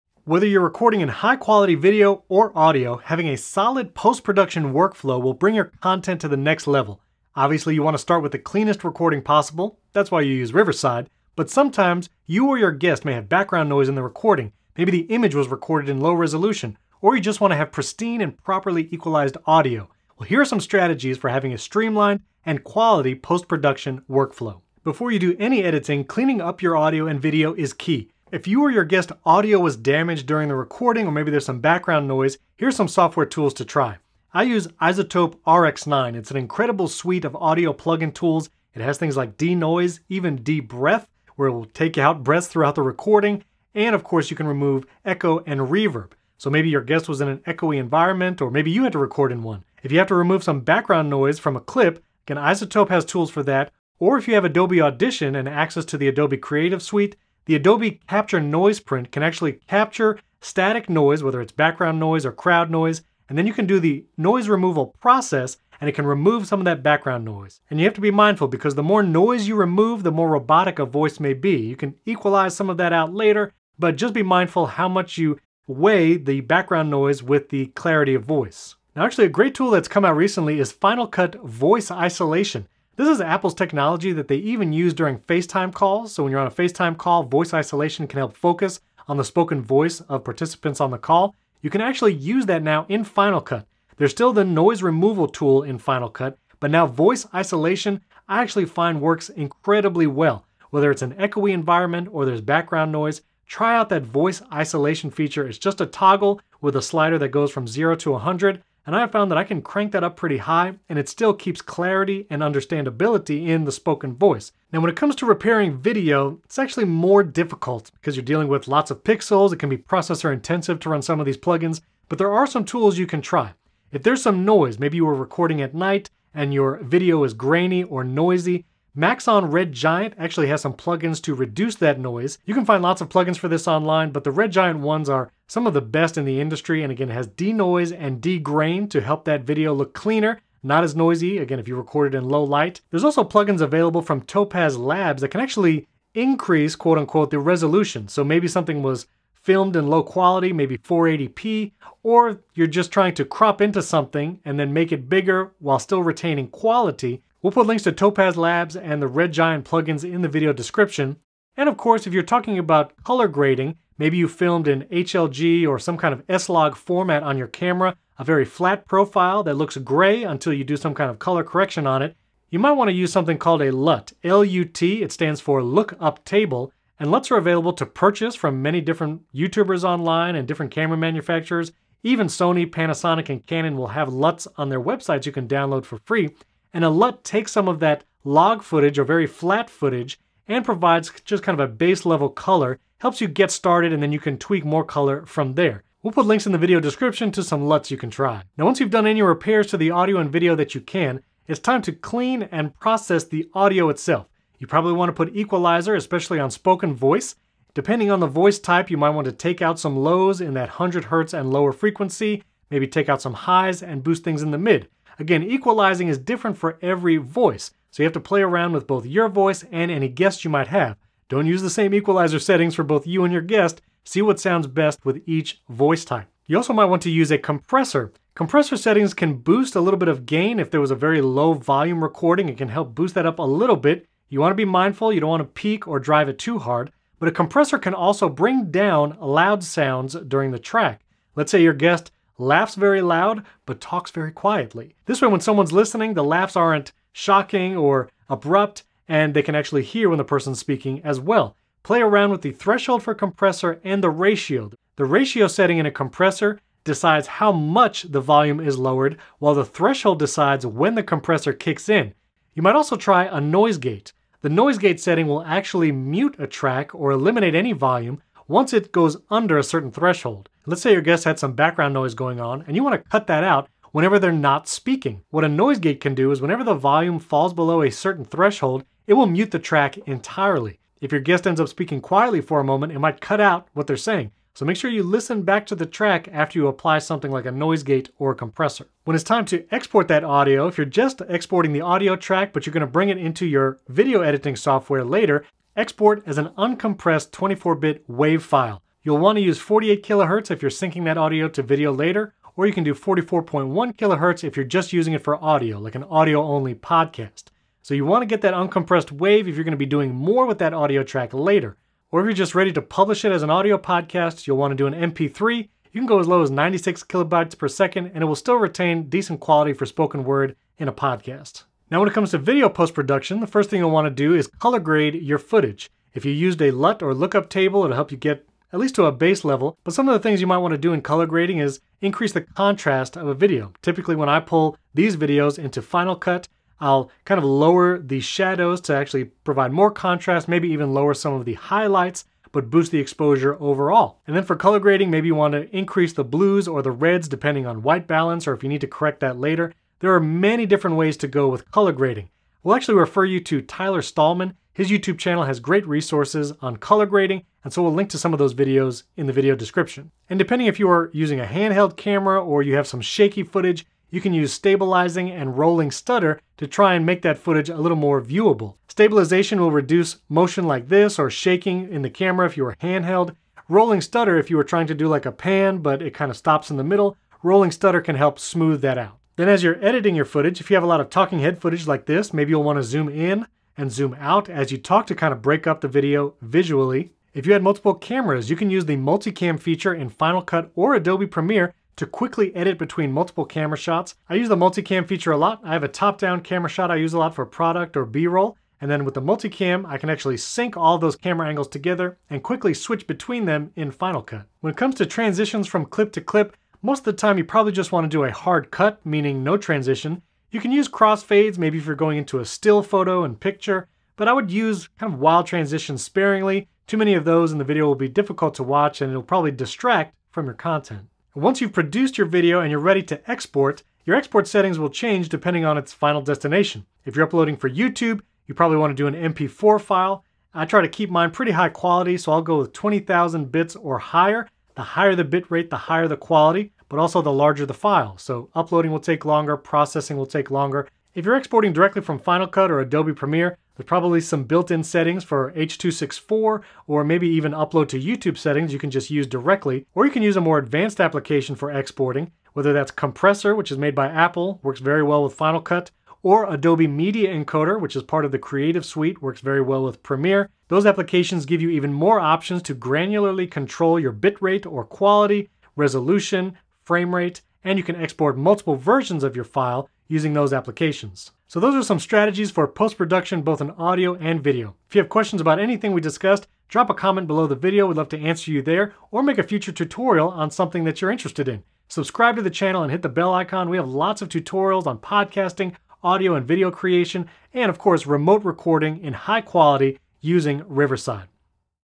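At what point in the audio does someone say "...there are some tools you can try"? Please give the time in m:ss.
2:02.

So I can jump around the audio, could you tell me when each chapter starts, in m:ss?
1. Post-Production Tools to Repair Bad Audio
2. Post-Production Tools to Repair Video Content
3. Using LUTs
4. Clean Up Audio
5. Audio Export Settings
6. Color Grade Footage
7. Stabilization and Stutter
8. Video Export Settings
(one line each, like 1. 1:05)
1. 0:28
2. 1:54
3. 2:44
4. 3:21
5. 4:48
6. 5:22
7. 6:04
8. 7:01.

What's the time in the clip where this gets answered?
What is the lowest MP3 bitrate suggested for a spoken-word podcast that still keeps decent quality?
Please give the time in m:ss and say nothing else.
5:16.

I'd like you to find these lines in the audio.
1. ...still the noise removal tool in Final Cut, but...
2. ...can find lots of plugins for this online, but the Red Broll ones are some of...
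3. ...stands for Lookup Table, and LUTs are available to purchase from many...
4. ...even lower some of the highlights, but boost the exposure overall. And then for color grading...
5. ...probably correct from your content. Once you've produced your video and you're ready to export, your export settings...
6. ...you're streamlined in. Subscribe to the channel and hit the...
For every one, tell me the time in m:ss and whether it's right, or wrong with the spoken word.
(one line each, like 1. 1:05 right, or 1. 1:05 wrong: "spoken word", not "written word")
1. 1:34 right
2. 2:12 wrong: "Giant", not "Broll"
3. 2:55 right
4. 5:40 right
5. 6:59 wrong: "distract", not "correct"
6. 8:01 wrong: "interested", not "streamlined".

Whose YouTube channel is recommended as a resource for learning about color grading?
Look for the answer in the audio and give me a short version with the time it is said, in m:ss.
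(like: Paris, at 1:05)
Tyler Stalman, at 5:53.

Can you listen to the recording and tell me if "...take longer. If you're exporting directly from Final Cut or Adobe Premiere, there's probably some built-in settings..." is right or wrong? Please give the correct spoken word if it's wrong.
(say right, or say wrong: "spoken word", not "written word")
right.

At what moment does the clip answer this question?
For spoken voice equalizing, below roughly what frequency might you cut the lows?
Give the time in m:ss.
3:30.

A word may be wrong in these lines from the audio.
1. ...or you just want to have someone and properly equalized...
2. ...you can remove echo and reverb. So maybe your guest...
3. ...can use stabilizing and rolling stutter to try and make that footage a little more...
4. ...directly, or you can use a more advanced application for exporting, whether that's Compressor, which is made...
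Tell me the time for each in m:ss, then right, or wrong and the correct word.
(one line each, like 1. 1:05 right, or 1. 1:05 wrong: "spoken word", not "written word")
1. 0:17 wrong: "pristine", not "someone"
2. 0:44 right
3. 6:04 right
4. 7:29 right.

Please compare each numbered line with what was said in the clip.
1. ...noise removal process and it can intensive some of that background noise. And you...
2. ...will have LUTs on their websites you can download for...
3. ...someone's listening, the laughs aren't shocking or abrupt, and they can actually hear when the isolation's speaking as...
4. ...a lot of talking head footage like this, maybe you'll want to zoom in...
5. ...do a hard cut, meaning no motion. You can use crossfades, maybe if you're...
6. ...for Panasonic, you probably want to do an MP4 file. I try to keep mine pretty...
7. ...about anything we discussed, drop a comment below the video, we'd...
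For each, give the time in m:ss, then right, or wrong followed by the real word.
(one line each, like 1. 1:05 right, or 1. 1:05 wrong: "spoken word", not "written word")
1. 1:04 wrong: "remove", not "intensive"
2. 3:03 right
3. 4:05 wrong: "person", not "isolation"
4. 6:20 right
5. 6:48 wrong: "transition", not "motion"
6. 7:07 wrong: "YouTube", not "Panasonic"
7. 7:55 right.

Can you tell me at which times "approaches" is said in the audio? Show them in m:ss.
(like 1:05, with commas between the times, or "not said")
not said.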